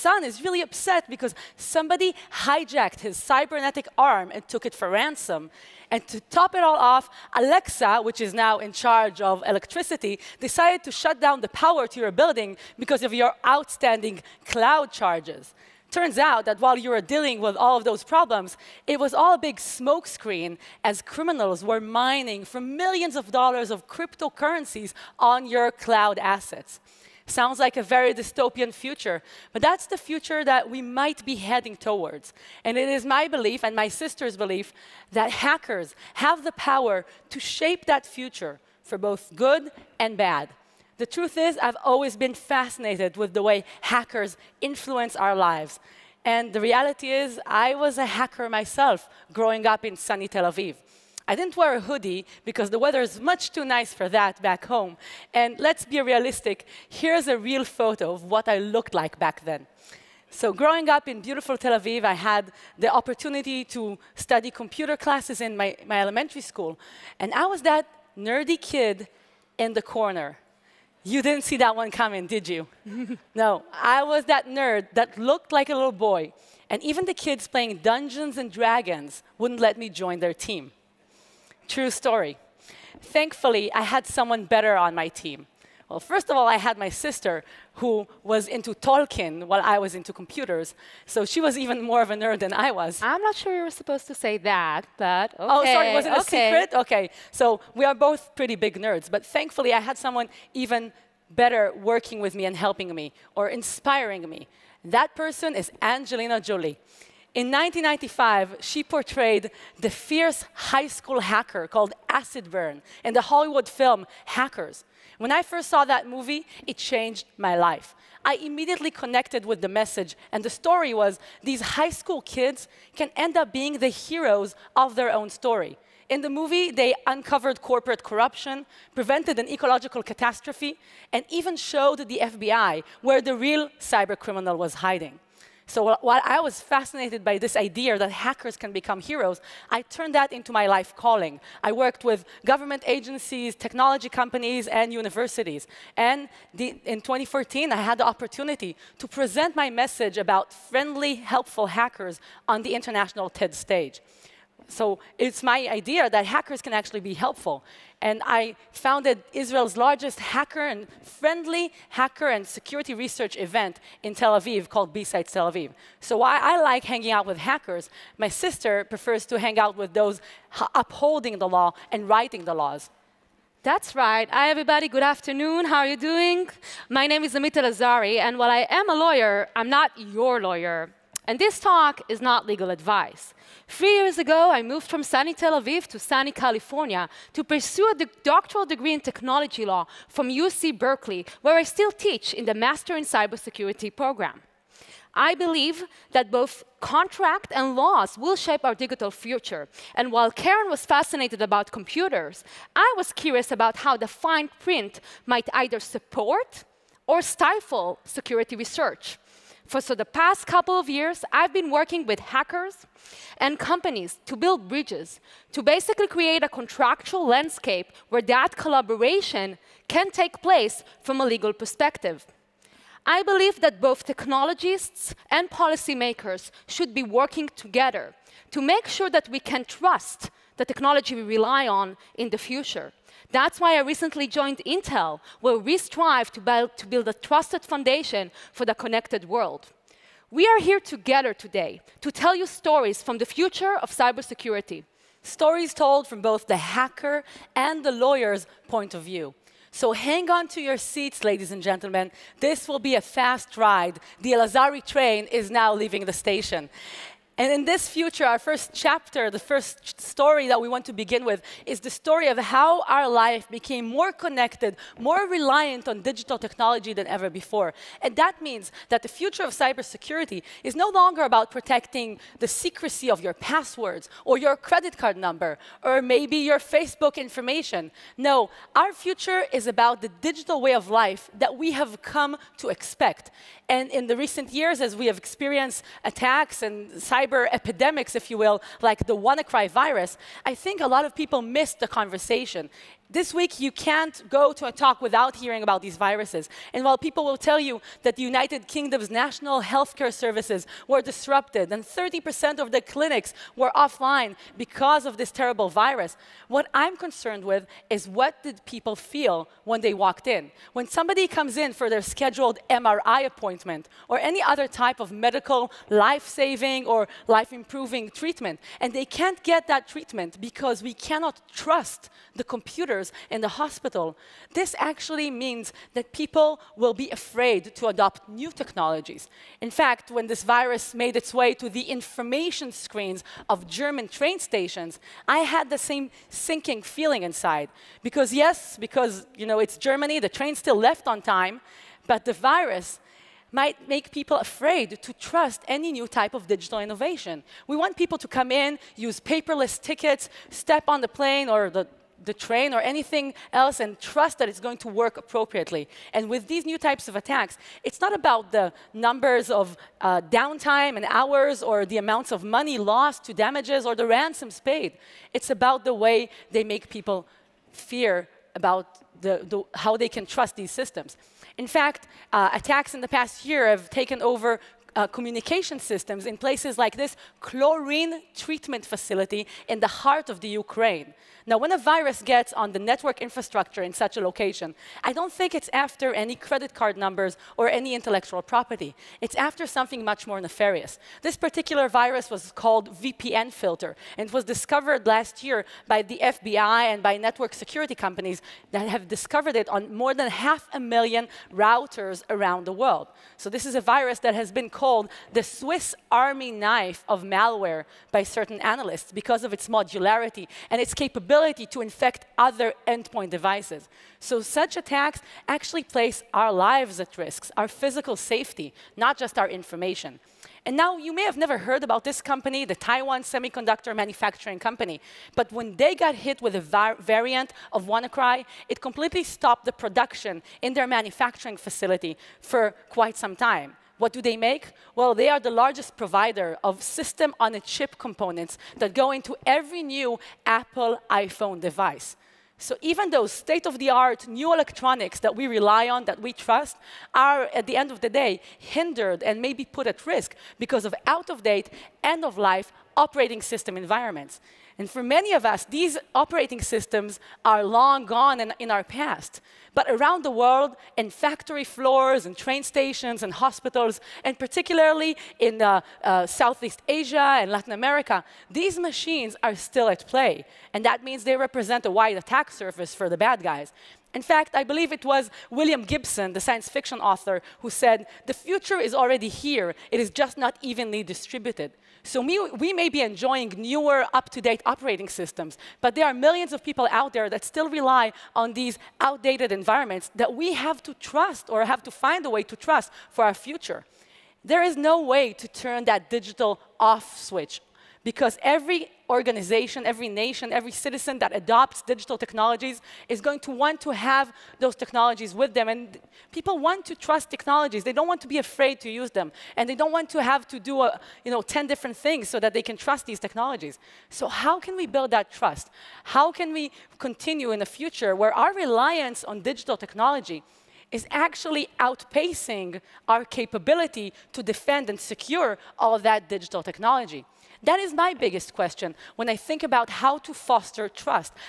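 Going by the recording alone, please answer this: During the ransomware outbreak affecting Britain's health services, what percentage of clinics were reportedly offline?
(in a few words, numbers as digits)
30%.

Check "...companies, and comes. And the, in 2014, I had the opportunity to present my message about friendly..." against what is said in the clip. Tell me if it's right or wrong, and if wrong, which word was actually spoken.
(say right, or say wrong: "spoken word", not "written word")
wrong: "universities", not "comes".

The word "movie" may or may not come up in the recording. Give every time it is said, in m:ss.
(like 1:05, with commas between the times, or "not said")
1:56, 2:06.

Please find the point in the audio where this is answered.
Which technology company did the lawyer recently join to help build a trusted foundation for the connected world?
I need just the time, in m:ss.
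3:54.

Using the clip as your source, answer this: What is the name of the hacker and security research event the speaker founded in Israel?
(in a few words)
BSides Tel Aviv.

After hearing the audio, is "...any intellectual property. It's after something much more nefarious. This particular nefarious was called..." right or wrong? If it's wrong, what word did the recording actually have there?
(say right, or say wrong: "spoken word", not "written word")
wrong: "virus", not "nefarious".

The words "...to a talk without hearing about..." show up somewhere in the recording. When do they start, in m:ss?
4:54.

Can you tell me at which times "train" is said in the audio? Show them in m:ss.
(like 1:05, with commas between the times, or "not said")
4:14, 5:34, 5:40, 5:52, 7:42.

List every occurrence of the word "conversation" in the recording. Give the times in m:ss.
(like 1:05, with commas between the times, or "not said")
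4:51.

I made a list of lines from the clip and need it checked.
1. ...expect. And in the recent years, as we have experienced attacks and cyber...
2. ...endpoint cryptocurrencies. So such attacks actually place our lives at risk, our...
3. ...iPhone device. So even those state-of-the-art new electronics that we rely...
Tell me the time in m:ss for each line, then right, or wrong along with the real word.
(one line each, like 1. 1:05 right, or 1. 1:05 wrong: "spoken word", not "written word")
1. 4:42 right
2. 6:52 wrong: "devices", not "cryptocurrencies"
3. 7:21 right.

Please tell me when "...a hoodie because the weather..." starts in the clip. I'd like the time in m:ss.
0:51.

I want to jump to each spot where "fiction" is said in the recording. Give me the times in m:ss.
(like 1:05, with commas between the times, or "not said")
7:56.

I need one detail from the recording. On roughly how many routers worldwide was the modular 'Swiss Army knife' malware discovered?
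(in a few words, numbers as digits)
Half a million.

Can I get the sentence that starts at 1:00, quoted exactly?
So growing up in beautiful Tel Aviv, I had the opportunity to study computer classes in my, my elementary school.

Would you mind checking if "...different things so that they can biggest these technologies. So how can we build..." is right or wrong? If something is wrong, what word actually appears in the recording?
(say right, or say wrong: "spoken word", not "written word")
wrong: "trust", not "biggest".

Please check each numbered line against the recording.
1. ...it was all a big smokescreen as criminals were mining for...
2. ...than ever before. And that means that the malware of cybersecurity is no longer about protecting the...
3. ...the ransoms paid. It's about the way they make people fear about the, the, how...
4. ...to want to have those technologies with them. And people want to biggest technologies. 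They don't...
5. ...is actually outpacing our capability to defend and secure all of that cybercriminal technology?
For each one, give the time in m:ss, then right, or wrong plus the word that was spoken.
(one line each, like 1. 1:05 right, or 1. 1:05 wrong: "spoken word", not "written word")
1. 0:18 right
2. 4:26 wrong: "future", not "malware"
3. 6:03 right
4. 8:23 wrong: "trust", not "biggest"
5. 8:40 wrong: "digital", not "cybercriminal".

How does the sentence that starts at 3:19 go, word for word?
And while Keren was fascinated about computers, I was curious about how the fine print might either support or stifle security research.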